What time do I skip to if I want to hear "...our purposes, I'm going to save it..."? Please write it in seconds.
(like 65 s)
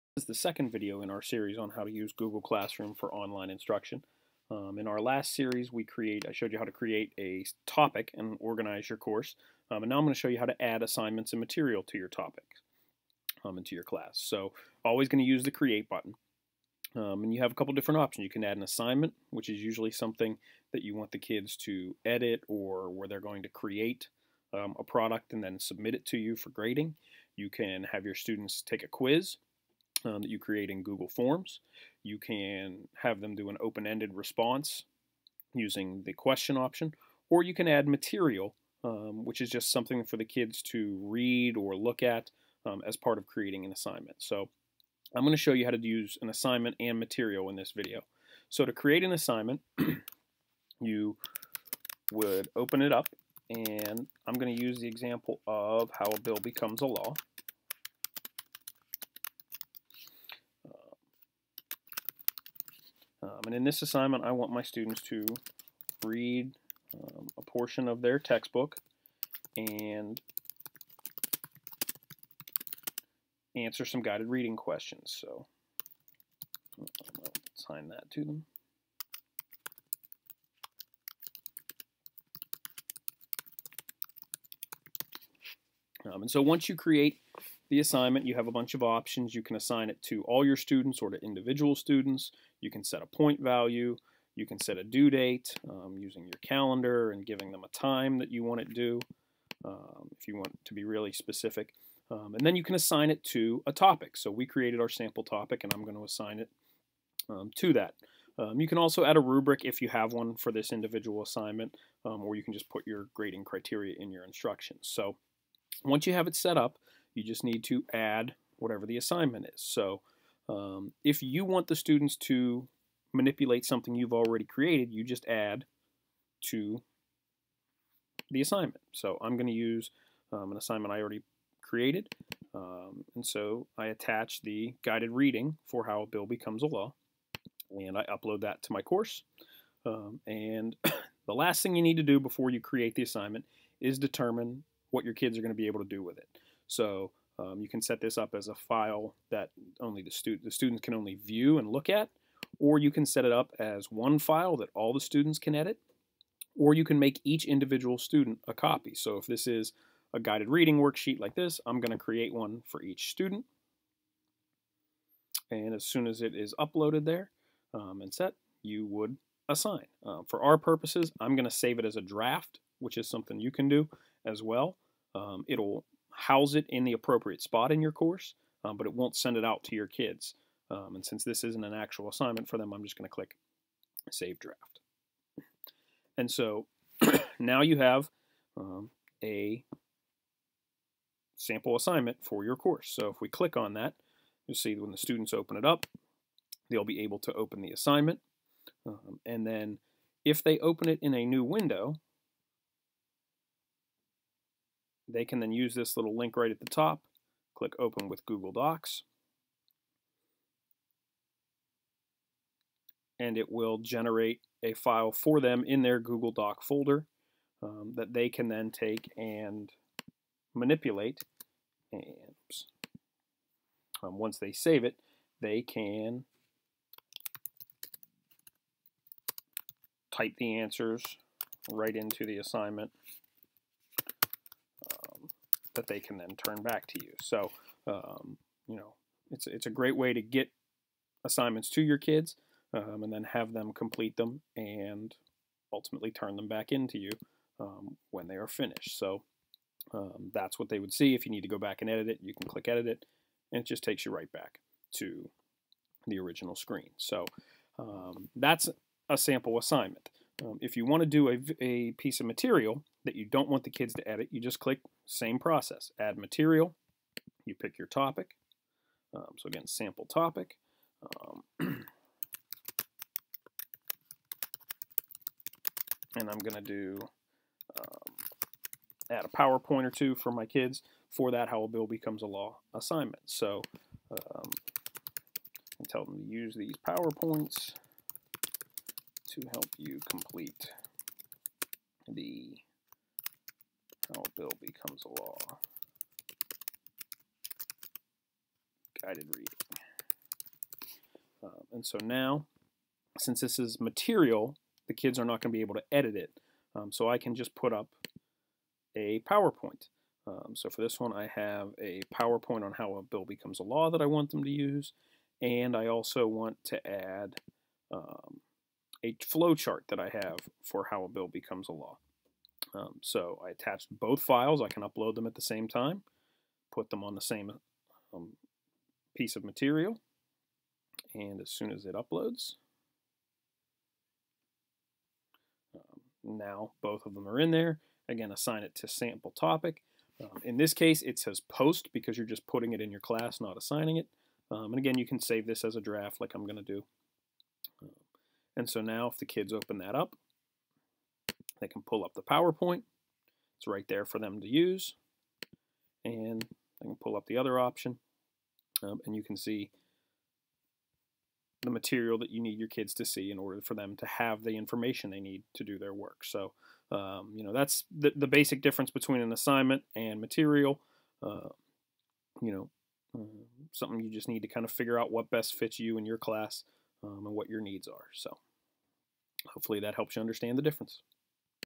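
170 s.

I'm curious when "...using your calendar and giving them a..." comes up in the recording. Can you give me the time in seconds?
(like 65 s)
95 s.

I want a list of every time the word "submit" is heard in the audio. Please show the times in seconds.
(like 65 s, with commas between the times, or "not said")
25 s.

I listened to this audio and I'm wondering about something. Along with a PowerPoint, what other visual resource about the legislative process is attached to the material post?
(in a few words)
A flow chart.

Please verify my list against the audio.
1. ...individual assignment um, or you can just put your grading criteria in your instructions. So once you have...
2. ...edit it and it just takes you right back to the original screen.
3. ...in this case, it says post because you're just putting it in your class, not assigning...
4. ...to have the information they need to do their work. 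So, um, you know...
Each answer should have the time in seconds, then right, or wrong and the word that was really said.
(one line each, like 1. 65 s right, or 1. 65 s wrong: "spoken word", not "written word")
1. 110 s right
2. 252 s right
3. 340 s right
4. 363 s right.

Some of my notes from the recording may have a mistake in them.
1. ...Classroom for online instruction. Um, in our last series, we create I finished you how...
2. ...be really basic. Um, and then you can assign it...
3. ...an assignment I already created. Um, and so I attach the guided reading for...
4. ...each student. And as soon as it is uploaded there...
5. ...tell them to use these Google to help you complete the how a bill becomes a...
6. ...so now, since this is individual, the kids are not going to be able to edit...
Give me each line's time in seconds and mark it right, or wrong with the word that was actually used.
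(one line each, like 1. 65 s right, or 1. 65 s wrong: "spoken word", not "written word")
1. 2 s wrong: "showed", not "finished"
2. 100 s wrong: "specific", not "basic"
3. 130 s right
4. 162 s right
5. 285 s wrong: "PowerPoints", not "Google"
6. 301 s wrong: "material", not "individual".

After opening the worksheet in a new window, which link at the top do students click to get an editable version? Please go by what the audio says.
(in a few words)
Open with Google Docs.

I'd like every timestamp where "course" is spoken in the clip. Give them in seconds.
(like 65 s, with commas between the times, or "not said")
8 s, 138 s, 177 s, 192 s.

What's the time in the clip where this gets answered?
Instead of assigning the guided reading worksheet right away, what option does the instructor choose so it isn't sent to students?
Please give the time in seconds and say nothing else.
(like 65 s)
184 s.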